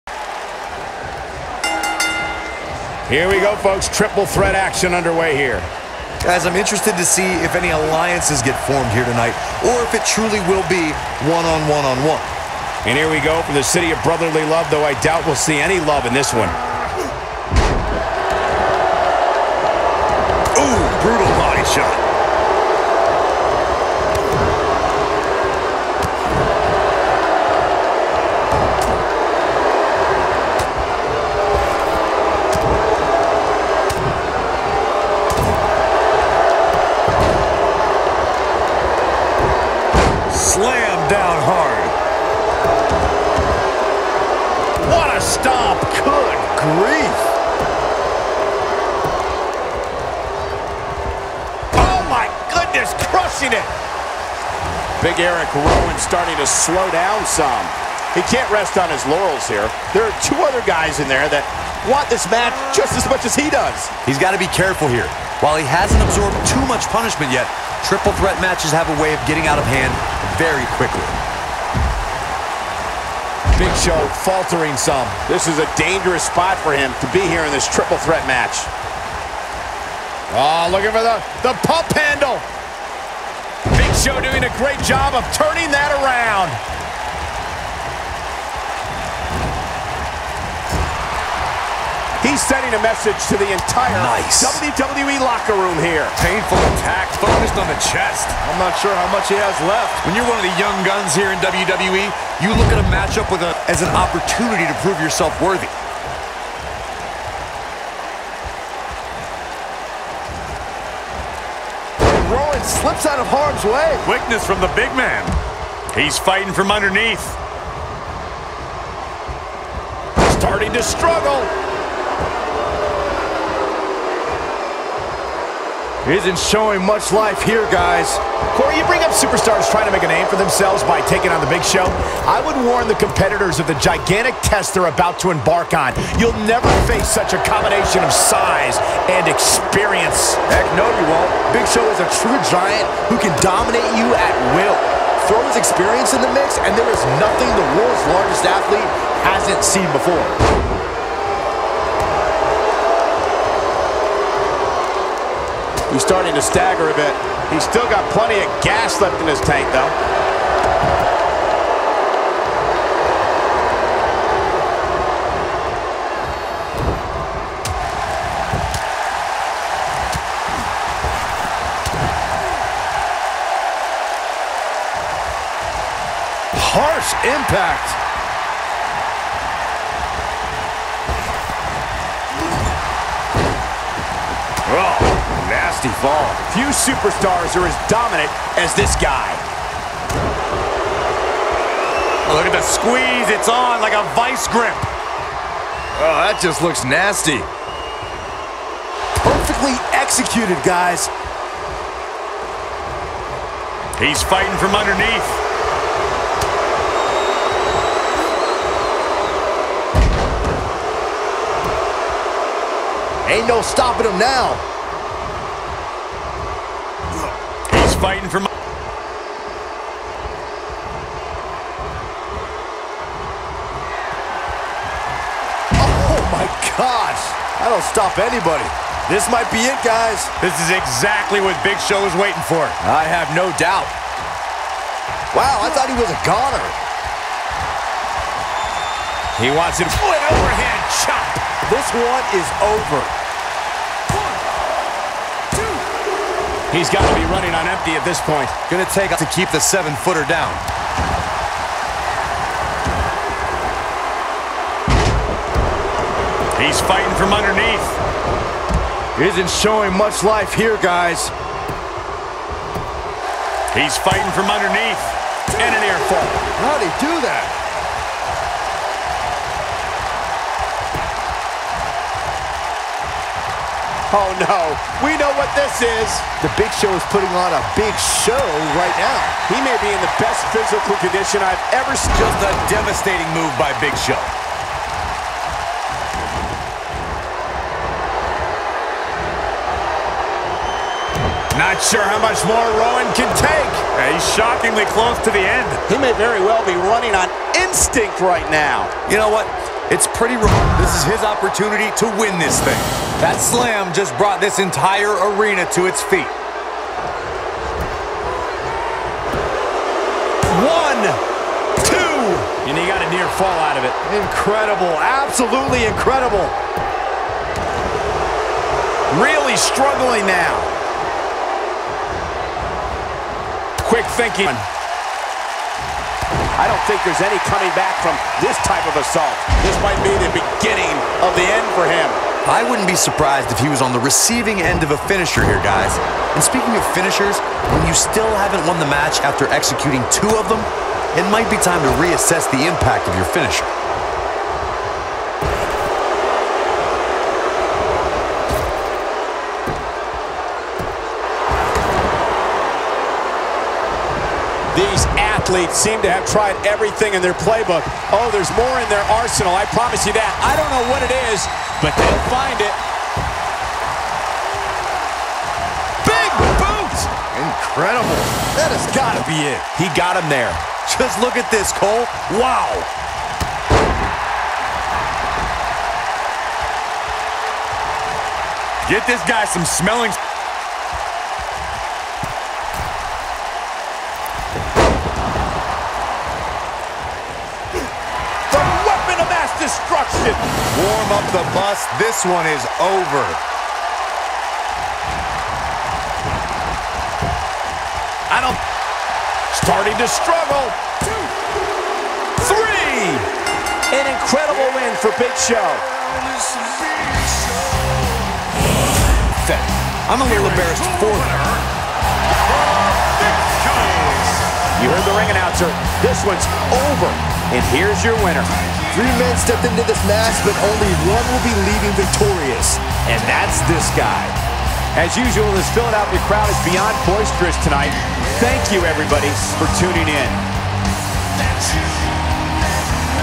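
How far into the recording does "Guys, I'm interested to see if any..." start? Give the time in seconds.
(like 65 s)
6 s.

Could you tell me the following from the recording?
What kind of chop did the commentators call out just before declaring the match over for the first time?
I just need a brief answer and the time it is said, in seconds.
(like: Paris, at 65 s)
overhand chop, at 239 s.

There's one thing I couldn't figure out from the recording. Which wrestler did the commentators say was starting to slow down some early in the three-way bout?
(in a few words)
Eric Rowan.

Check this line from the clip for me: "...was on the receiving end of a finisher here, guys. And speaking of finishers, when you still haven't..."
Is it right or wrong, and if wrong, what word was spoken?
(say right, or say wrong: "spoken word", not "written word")
right.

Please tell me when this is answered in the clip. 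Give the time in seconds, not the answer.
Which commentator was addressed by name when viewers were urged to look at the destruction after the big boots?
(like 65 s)
371 s.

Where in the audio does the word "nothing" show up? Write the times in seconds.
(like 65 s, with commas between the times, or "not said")
147 s.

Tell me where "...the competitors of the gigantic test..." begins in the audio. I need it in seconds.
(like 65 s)
132 s.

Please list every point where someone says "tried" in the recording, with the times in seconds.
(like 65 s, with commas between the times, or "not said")
356 s.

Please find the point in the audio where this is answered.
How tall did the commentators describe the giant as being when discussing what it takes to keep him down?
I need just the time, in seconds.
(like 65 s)
249 s.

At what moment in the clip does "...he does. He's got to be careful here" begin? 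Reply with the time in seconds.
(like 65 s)
63 s.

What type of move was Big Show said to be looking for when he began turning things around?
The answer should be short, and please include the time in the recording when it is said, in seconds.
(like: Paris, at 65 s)
pump handle, at 81 s.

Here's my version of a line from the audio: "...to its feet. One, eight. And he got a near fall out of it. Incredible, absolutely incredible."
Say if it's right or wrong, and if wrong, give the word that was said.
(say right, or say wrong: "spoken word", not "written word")
wrong: "two", not "eight".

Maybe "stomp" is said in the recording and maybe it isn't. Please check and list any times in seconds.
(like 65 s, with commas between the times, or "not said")
45 s.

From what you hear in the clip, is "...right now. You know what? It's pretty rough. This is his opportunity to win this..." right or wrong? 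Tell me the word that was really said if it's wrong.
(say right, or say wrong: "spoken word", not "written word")
right.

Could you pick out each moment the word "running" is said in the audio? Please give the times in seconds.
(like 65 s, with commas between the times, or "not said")
247 s, 296 s.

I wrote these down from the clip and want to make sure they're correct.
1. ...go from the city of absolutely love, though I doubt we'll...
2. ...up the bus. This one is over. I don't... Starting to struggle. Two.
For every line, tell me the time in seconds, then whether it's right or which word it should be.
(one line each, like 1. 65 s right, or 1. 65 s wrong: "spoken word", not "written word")
1. 13 s wrong: "brotherly", not "absolutely"
2. 391 s right.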